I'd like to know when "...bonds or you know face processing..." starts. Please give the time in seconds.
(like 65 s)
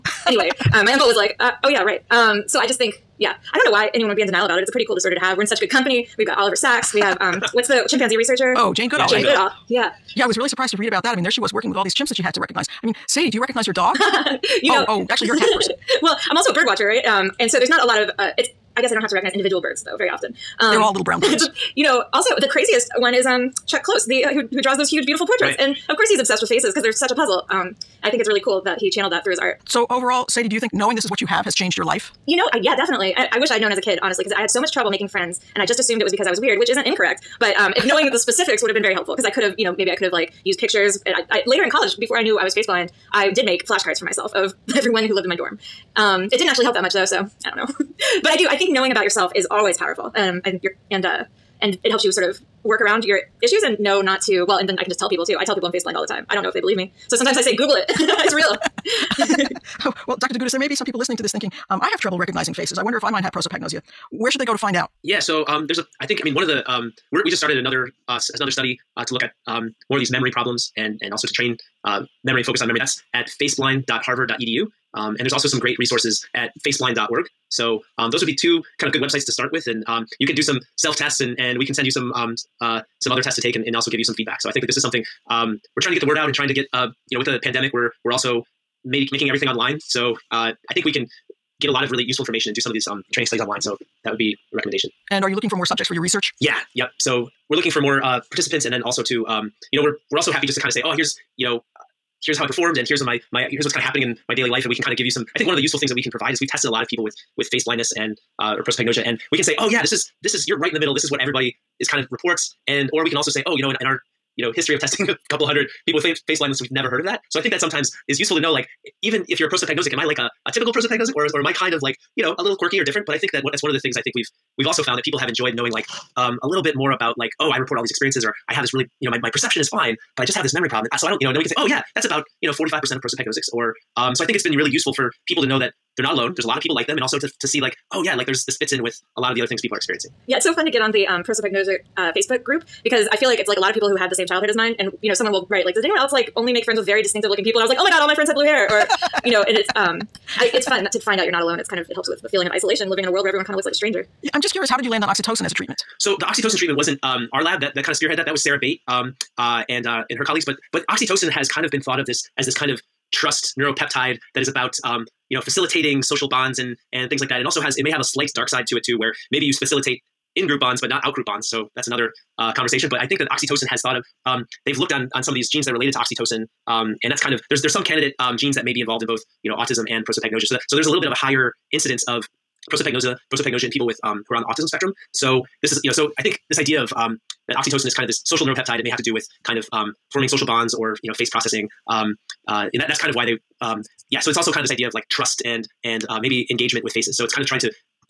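190 s.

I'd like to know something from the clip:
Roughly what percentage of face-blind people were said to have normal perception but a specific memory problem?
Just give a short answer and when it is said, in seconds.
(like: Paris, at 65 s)
45%, at 132 s.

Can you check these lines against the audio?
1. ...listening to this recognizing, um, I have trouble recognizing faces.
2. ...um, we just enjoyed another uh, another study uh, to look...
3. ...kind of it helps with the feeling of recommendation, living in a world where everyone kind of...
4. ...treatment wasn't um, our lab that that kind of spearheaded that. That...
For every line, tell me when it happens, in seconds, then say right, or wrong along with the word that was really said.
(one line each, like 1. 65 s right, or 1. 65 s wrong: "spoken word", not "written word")
1. 60 s wrong: "thinking", not "recognizing"
2. 66 s wrong: "started", not "enjoyed"
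3. 151 s wrong: "isolation", not "recommendation"
4. 156 s right.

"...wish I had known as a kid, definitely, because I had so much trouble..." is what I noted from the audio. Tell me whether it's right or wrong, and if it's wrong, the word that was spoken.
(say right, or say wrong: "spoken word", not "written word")
wrong: "honestly", not "definitely".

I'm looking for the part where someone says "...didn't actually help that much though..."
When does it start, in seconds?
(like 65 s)
46 s.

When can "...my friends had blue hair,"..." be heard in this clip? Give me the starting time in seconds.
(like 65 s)
148 s.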